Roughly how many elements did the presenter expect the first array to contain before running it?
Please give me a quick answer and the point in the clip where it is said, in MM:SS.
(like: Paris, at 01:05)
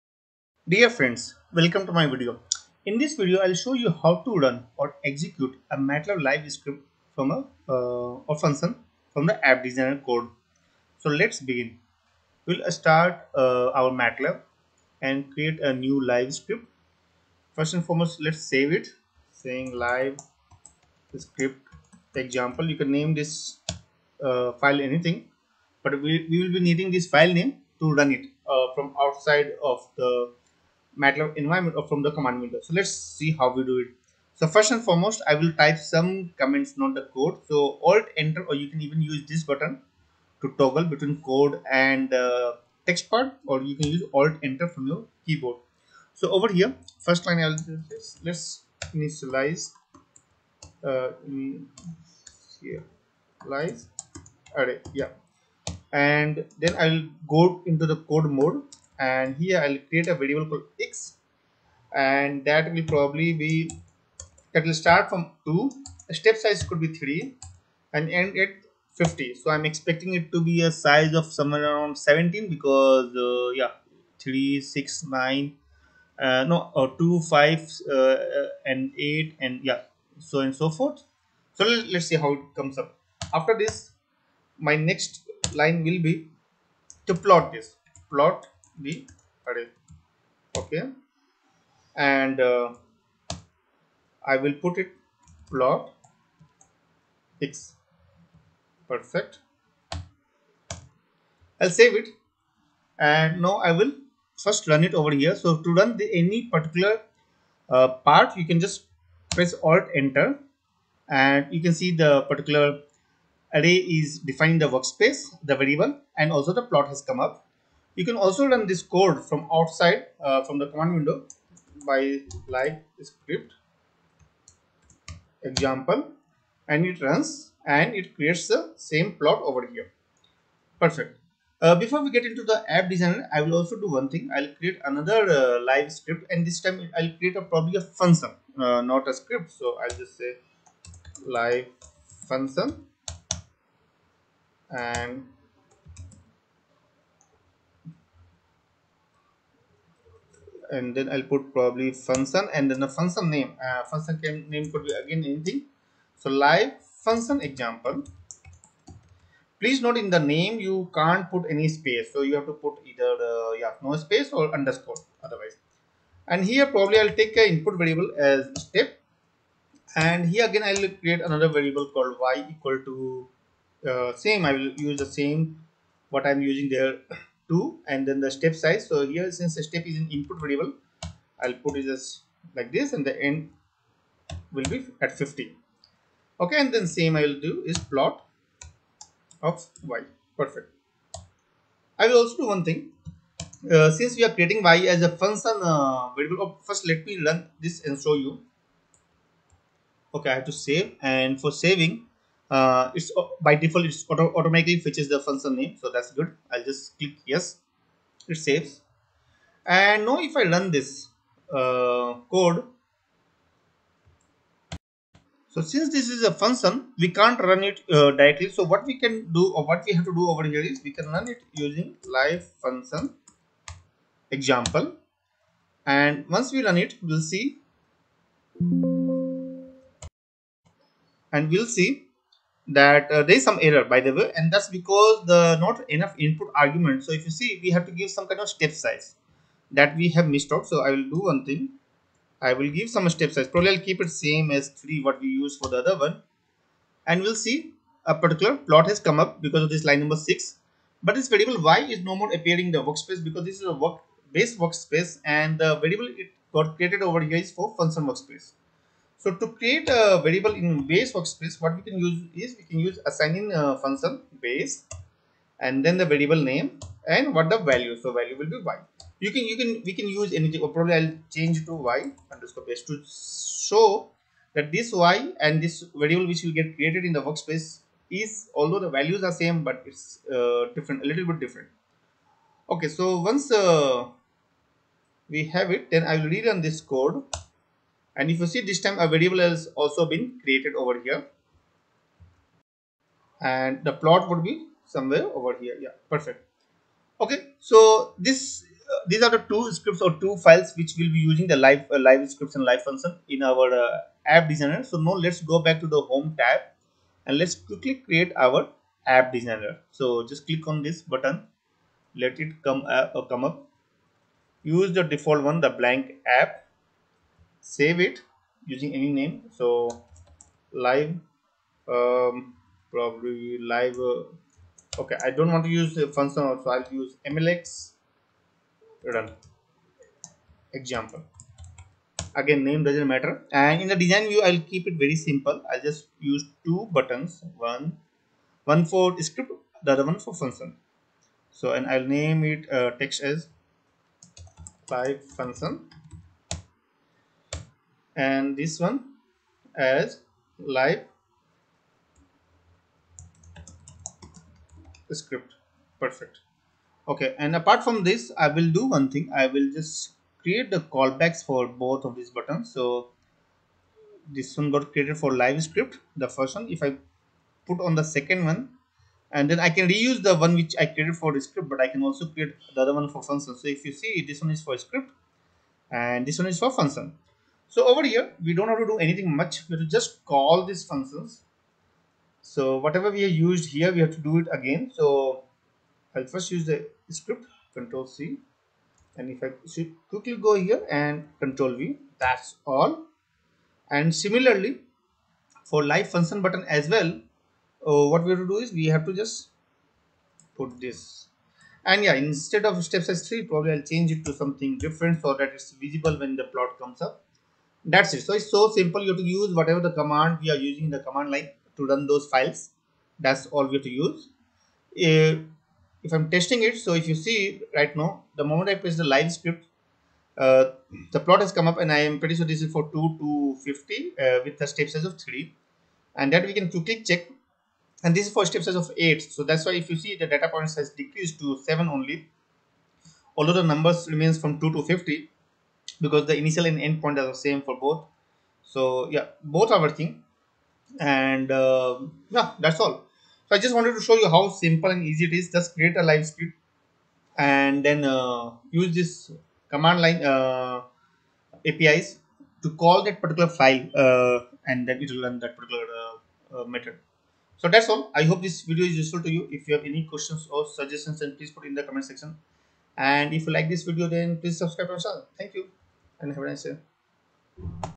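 17, at 01:11.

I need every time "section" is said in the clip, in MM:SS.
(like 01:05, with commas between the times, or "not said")
07:42.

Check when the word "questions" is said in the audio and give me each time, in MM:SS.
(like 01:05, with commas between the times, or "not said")
07:40.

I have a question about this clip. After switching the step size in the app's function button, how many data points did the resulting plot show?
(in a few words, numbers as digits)
7.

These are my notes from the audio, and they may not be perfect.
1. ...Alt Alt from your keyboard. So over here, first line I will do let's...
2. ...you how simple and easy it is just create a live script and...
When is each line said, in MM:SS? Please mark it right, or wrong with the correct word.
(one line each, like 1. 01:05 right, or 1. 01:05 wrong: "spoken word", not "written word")
1. 00:44 wrong: "Enter", not "Alt"
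2. 07:24 right.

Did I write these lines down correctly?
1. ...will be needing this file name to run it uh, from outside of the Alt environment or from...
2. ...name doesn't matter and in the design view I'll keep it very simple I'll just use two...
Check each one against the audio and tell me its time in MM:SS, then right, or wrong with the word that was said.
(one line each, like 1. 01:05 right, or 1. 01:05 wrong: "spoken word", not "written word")
1. 00:26 wrong: "MATLAB", not "Alt"
2. 05:32 right.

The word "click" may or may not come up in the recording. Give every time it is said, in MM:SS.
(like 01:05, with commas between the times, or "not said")
03:26, 05:10.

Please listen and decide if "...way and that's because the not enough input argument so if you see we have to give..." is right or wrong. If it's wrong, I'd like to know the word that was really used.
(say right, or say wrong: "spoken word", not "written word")
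right.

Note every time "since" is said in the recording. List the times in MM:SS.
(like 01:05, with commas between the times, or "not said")
02:59, 03:13, 03:35.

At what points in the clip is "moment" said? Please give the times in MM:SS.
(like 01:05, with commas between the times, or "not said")
06:58.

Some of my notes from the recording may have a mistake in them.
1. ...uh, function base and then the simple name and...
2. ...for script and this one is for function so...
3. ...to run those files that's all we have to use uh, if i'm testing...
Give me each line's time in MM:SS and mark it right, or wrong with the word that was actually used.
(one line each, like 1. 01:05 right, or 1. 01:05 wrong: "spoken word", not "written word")
1. 04:23 wrong: "variable", not "simple"
2. 06:14 right
3. 06:51 right.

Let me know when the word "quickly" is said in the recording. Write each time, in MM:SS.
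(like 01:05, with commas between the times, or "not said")
05:07, 06:30, 07:06.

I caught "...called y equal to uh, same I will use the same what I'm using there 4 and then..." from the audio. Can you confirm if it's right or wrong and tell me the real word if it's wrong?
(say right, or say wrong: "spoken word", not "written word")
wrong: "2", not "4".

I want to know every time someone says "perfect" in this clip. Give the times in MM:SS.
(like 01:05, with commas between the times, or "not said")
01:38, 02:10, 03:10, 04:56, 05:55.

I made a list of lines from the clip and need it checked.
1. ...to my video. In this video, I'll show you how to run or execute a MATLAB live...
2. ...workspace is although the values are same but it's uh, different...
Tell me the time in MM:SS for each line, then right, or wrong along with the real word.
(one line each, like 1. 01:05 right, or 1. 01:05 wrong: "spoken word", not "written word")
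1. 00:01 right
2. 04:37 right.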